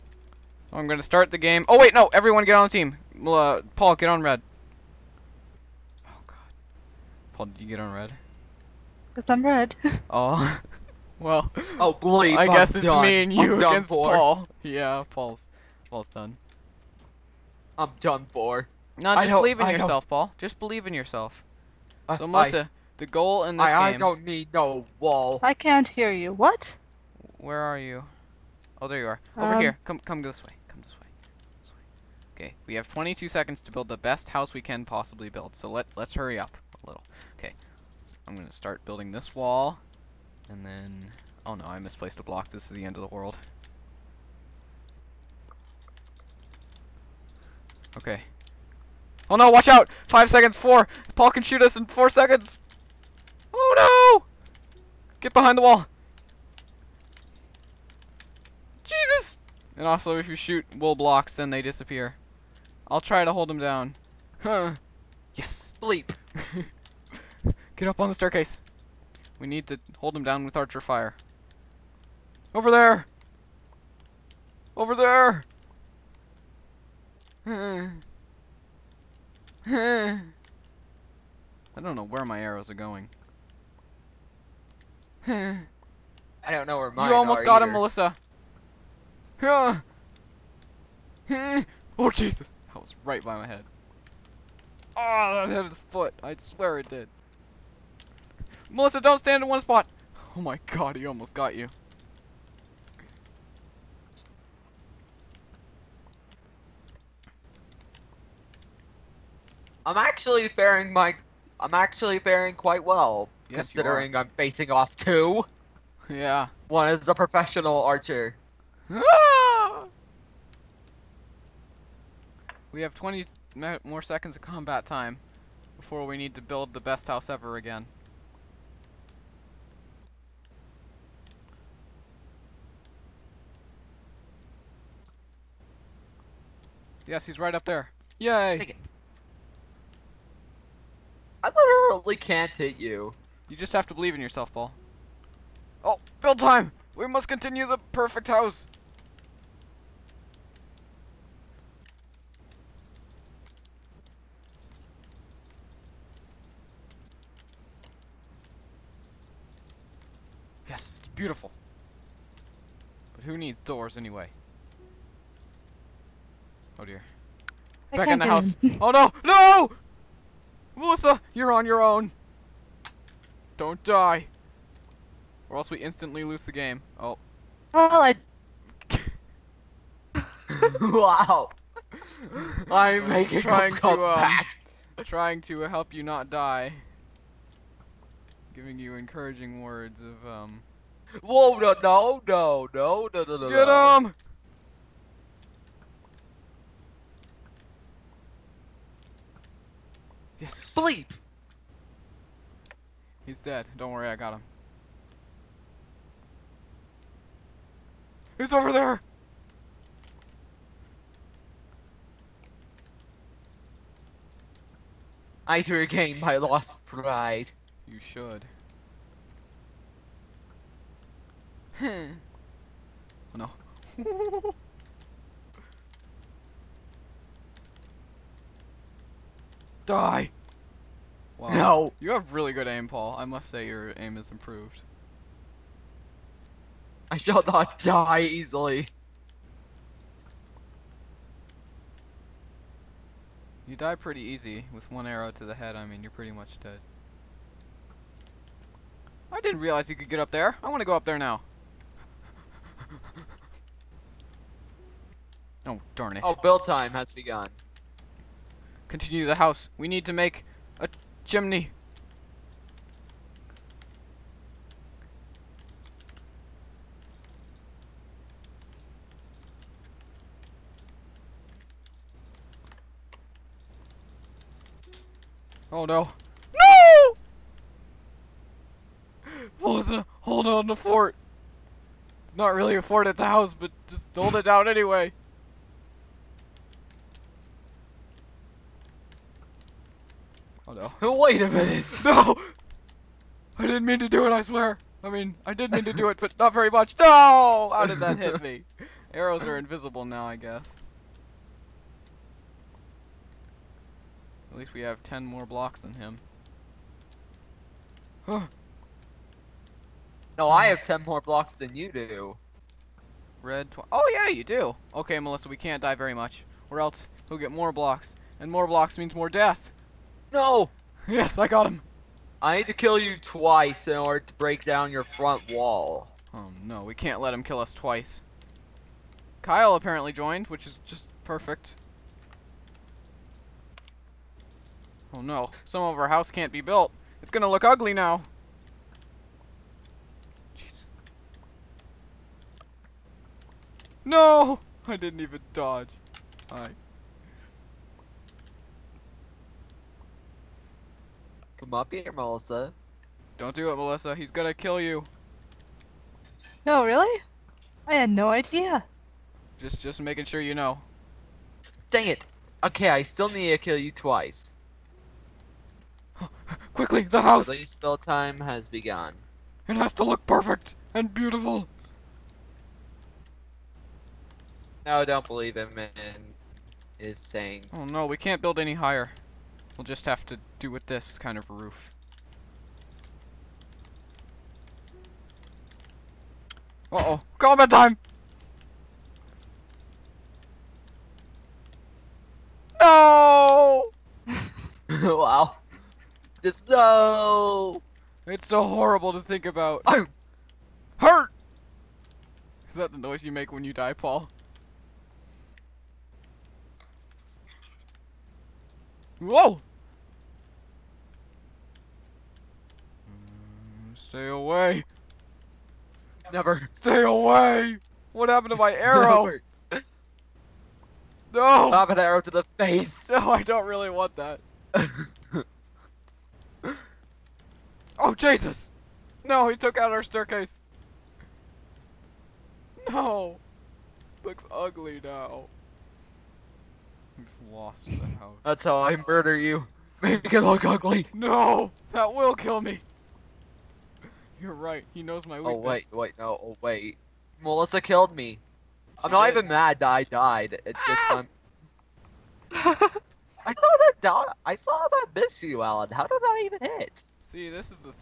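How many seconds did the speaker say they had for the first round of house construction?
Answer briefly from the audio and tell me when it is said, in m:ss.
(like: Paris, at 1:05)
22, at 0:32.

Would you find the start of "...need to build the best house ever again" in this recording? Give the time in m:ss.
2:06.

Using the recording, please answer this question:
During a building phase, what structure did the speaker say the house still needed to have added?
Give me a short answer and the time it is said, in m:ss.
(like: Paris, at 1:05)
A chimney, at 4:20.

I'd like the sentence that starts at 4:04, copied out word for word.
With one arrow to the head, I mean, you're pretty much dead.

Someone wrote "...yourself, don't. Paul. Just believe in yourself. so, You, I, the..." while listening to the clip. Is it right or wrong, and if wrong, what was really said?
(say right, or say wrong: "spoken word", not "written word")
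wrong: "Melissa", not "You".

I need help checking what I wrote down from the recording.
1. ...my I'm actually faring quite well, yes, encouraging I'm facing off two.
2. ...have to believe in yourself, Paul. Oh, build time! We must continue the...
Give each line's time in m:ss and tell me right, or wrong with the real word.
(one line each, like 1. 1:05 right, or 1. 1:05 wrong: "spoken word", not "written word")
1. 1:50 wrong: "considering", not "encouraging"
2. 2:23 right.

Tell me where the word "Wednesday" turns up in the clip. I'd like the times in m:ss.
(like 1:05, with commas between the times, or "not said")
not said.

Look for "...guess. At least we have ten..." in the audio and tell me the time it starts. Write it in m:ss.
5:00.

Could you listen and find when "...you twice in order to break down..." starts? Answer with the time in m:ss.
5:22.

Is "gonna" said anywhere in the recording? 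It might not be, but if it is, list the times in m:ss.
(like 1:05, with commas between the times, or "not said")
5:37, 5:54.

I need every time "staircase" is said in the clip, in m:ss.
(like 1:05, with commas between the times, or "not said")
1:08, 7:10.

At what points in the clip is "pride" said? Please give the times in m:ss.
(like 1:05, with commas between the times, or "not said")
3:36.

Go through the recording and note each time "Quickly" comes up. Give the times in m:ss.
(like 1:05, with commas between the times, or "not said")
6:06.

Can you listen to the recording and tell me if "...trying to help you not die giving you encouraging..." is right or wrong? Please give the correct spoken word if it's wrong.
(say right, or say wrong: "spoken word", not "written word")
right.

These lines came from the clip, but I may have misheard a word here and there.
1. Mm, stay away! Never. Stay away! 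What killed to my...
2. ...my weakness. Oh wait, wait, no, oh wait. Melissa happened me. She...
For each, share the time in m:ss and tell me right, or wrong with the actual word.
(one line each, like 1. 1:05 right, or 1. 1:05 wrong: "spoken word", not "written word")
1. 6:53 wrong: "happened", not "killed"
2. 7:25 wrong: "killed", not "happened".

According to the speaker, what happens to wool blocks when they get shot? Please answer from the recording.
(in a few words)
They disappear.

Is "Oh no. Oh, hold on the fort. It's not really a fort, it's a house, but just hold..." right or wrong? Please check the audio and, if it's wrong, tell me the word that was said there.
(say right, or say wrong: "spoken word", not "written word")
right.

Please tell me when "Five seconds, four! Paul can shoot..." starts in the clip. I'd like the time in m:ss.
0:50.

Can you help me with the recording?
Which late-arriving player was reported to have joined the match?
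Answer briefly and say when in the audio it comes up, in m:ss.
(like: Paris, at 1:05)
Kyle, at 5:29.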